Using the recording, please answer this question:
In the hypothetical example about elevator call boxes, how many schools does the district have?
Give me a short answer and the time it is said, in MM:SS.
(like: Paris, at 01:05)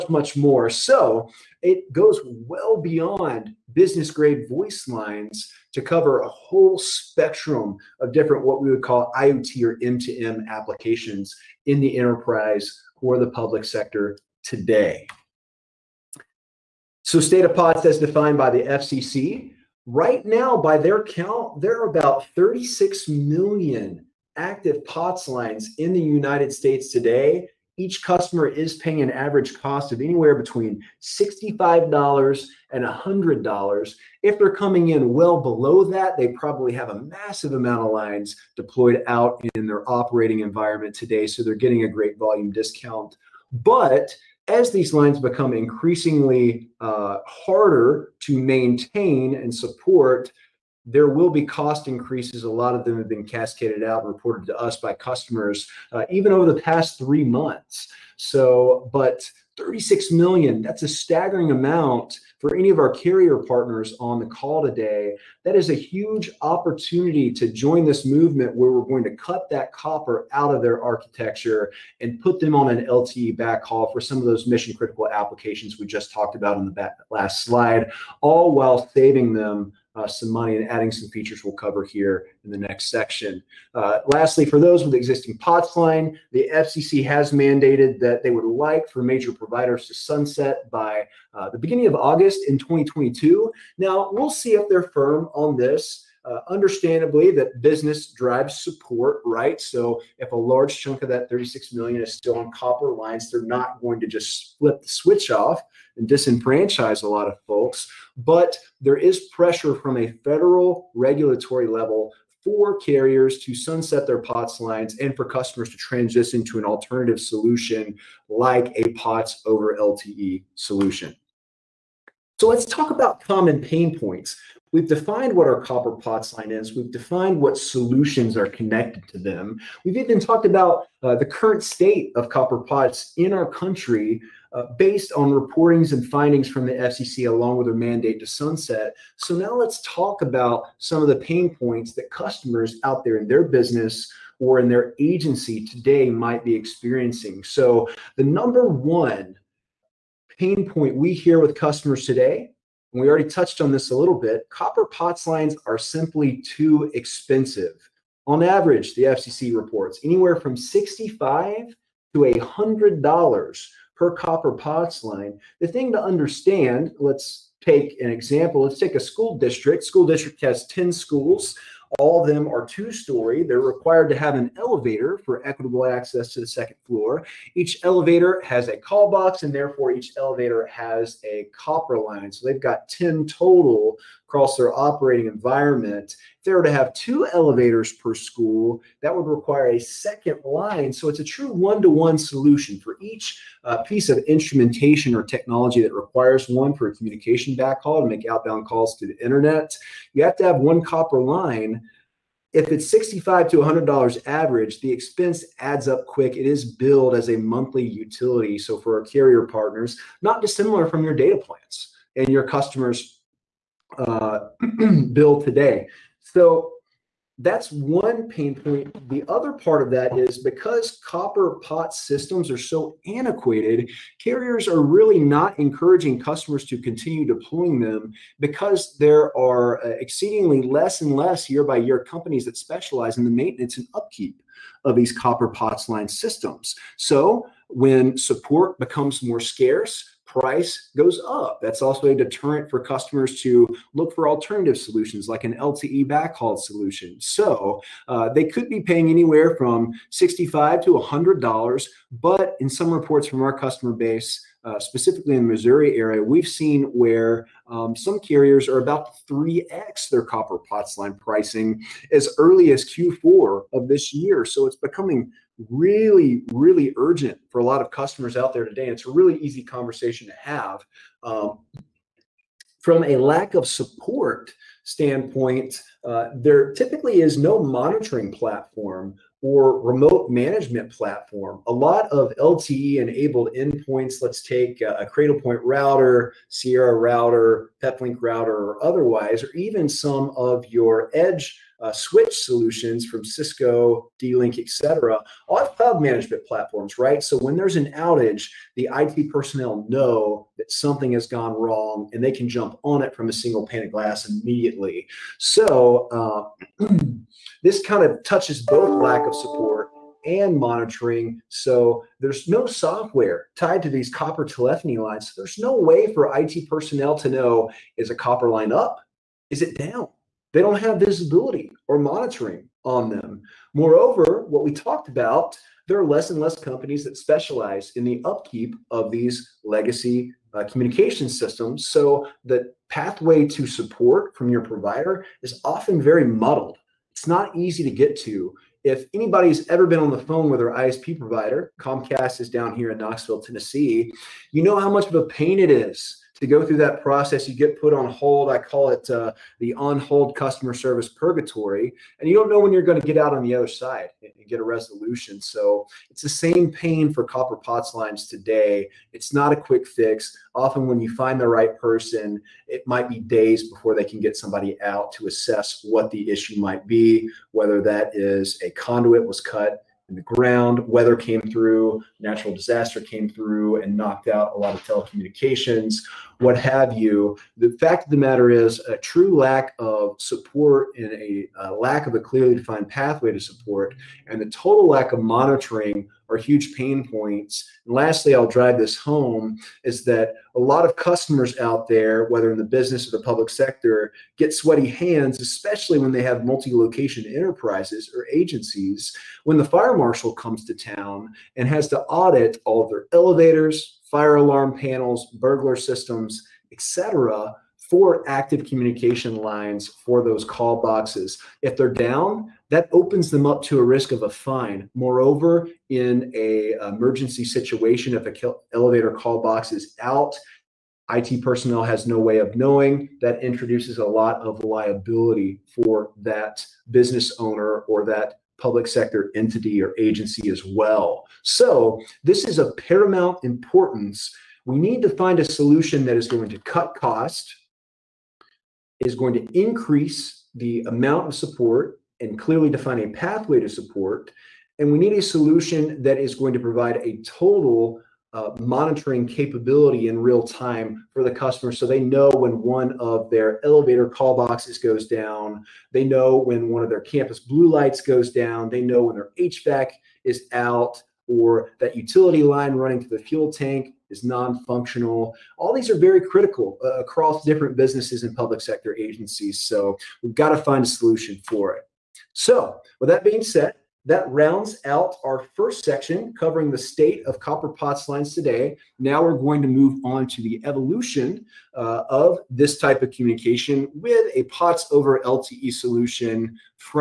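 10, at 02:50.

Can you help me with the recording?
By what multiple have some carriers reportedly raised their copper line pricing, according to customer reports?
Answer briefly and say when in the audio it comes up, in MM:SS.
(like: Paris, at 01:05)
3x, at 04:19.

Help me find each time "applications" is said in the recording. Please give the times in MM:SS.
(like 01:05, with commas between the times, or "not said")
00:10, 01:15.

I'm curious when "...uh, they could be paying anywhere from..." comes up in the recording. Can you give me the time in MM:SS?
04:08.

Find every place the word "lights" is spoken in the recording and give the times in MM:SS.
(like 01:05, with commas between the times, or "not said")
07:37.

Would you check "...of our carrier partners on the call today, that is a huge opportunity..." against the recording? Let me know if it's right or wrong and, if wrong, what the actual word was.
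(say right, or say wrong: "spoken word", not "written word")
right.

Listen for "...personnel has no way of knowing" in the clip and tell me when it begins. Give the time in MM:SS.
07:01.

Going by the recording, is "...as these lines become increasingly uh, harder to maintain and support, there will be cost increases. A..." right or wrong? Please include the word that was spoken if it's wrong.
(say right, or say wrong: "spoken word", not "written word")
right.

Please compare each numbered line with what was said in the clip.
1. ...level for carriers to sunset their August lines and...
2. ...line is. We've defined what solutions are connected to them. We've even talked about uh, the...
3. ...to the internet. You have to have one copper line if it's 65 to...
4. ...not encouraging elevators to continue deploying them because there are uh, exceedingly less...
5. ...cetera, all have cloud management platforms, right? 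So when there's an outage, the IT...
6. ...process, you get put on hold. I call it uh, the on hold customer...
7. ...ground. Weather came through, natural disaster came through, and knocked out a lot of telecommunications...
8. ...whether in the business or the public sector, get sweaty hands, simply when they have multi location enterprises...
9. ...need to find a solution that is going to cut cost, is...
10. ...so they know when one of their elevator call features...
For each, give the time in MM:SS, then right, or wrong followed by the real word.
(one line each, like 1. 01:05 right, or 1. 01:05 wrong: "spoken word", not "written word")
1. 01:51 wrong: "POTS", not "August"
2. 02:06 right
3. 03:18 right
4. 03:45 wrong: "customers", not "elevators"
5. 04:54 right
6. 05:47 right
7. 06:10 right
8. 06:32 wrong: "especially", not "simply"
9. 07:14 right
10. 07:31 wrong: "boxes", not "features".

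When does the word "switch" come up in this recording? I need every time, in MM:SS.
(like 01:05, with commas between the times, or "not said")
01:44, 04:51.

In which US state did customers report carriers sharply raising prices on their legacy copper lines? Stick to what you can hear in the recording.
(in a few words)
Missouri.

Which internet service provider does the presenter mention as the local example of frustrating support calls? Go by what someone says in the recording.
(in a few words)
Comcast.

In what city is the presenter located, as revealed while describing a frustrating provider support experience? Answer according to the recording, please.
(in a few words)
Knoxville, Tennessee.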